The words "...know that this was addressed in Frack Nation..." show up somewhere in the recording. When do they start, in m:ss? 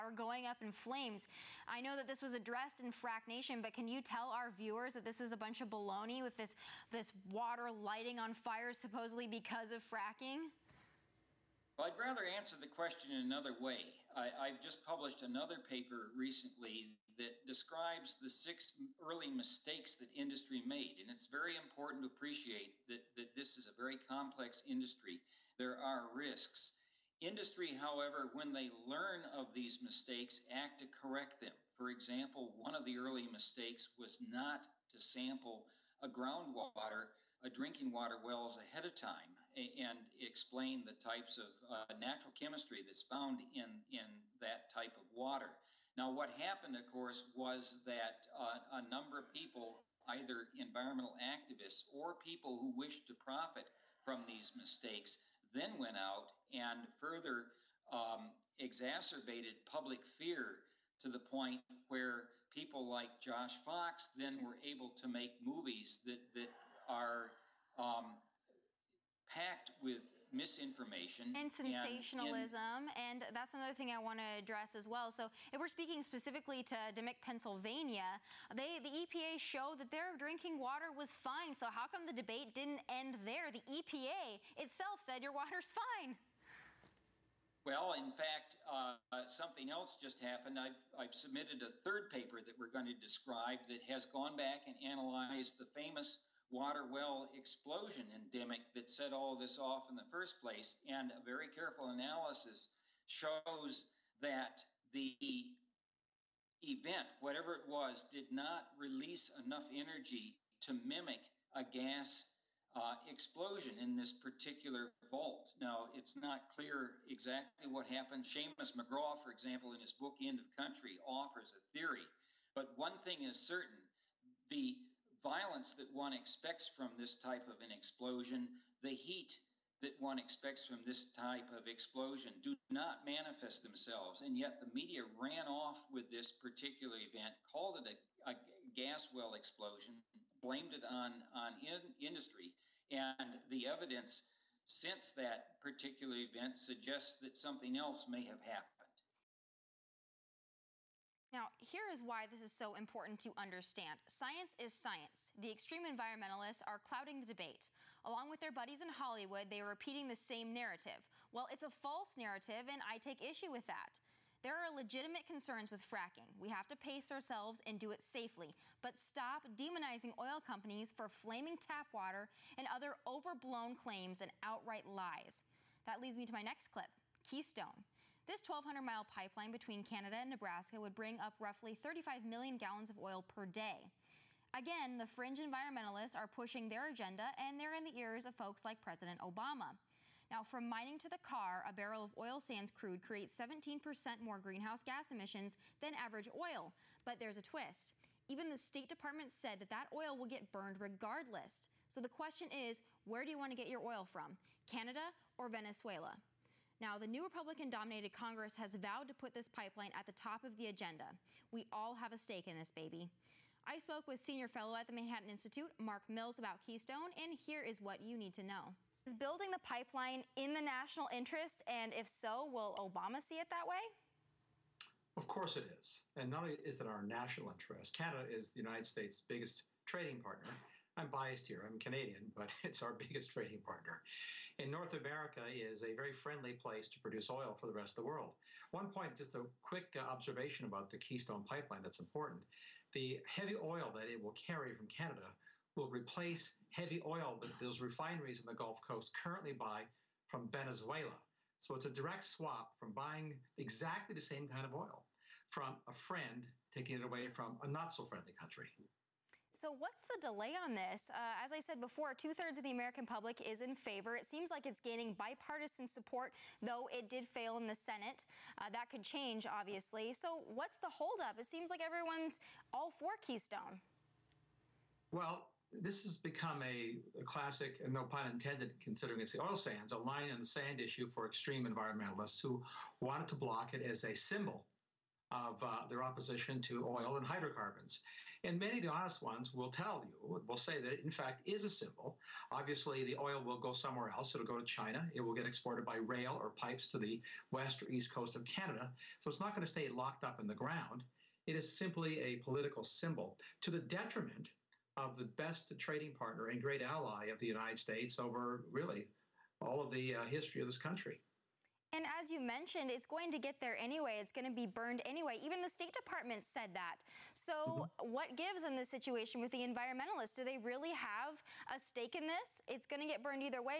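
0:01.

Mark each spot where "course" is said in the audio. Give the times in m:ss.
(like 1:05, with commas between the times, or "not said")
0:46, 3:45.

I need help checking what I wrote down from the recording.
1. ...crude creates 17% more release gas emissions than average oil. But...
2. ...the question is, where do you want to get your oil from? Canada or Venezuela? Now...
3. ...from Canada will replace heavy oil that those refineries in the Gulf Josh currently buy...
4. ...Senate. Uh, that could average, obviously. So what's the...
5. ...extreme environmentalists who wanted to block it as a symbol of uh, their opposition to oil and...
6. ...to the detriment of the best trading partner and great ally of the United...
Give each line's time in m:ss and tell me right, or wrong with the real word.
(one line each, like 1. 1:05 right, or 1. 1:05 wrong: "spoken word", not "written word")
1. 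3:12 wrong: "greenhouse", not "release"
2. 3:22 right
3. 4:04 wrong: "Coast", not "Josh"
4. 4:27 wrong: "change", not "average"
5. 4:41 right
6. 5:03 right.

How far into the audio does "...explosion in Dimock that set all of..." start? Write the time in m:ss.
1:37.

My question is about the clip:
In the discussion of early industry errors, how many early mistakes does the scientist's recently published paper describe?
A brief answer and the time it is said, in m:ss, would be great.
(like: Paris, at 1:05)
6, at 0:18.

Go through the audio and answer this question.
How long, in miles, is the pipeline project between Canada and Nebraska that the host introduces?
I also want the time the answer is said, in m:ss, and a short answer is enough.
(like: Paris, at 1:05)
1,200 miles, at 2:58.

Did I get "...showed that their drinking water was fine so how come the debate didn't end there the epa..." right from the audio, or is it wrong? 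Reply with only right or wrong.
right.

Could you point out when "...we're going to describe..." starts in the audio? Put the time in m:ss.
1:32.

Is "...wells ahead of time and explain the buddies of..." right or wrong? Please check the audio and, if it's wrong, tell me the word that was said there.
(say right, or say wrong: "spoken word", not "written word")
wrong: "types", not "buddies".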